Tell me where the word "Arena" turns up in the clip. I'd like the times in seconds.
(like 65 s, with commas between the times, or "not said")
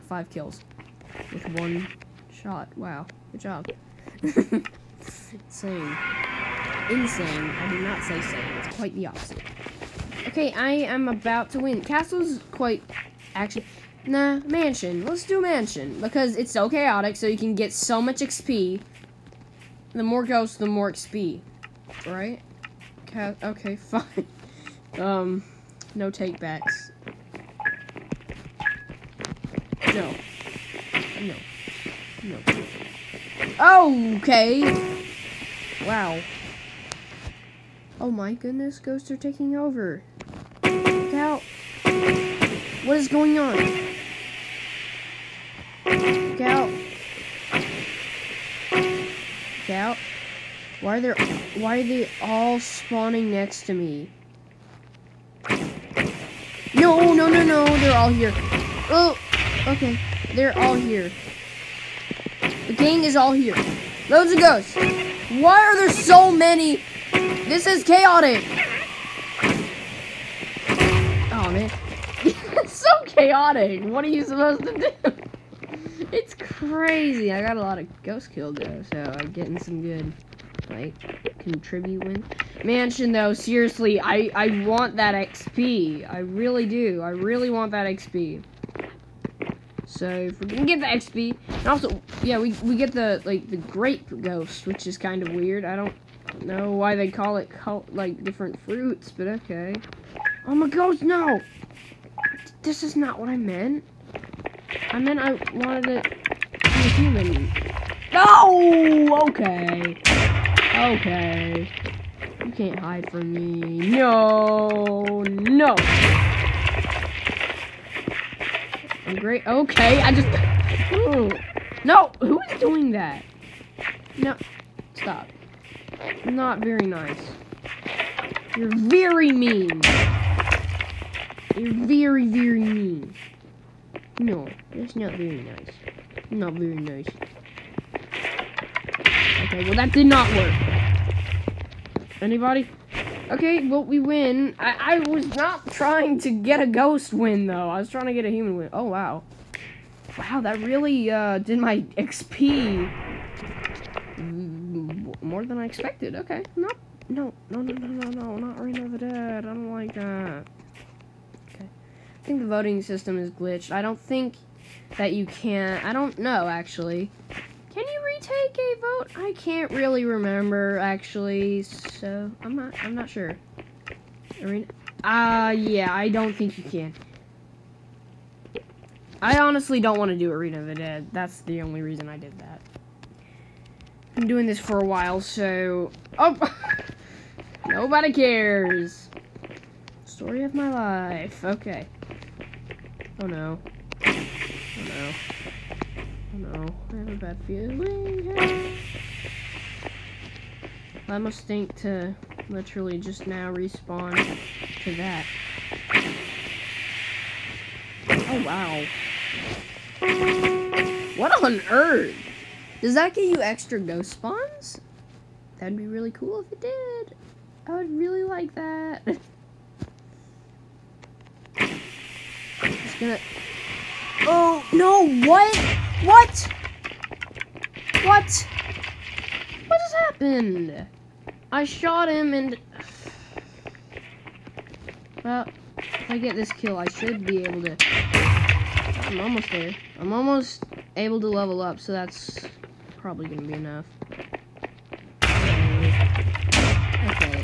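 174 s, 180 s.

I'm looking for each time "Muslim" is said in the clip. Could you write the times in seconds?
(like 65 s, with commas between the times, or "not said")
not said.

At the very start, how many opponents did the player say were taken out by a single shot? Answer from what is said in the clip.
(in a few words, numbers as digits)
5.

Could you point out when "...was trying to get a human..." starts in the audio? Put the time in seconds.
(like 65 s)
147 s.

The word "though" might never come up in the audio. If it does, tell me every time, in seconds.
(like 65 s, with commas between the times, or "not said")
78 s, 83 s, 147 s.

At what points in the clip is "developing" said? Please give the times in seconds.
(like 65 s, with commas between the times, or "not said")
not said.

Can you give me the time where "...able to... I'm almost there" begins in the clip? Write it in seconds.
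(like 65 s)
237 s.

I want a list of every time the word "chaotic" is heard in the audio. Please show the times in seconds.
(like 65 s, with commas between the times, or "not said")
16 s, 67 s, 73 s.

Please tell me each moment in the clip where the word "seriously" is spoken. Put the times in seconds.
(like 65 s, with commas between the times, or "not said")
83 s.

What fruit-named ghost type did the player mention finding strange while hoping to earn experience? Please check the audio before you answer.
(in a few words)
Grape Ghost.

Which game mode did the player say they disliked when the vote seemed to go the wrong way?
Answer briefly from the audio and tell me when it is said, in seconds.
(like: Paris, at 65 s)
Reign of the Dead, at 158 s.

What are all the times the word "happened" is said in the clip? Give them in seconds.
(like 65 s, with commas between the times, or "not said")
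229 s.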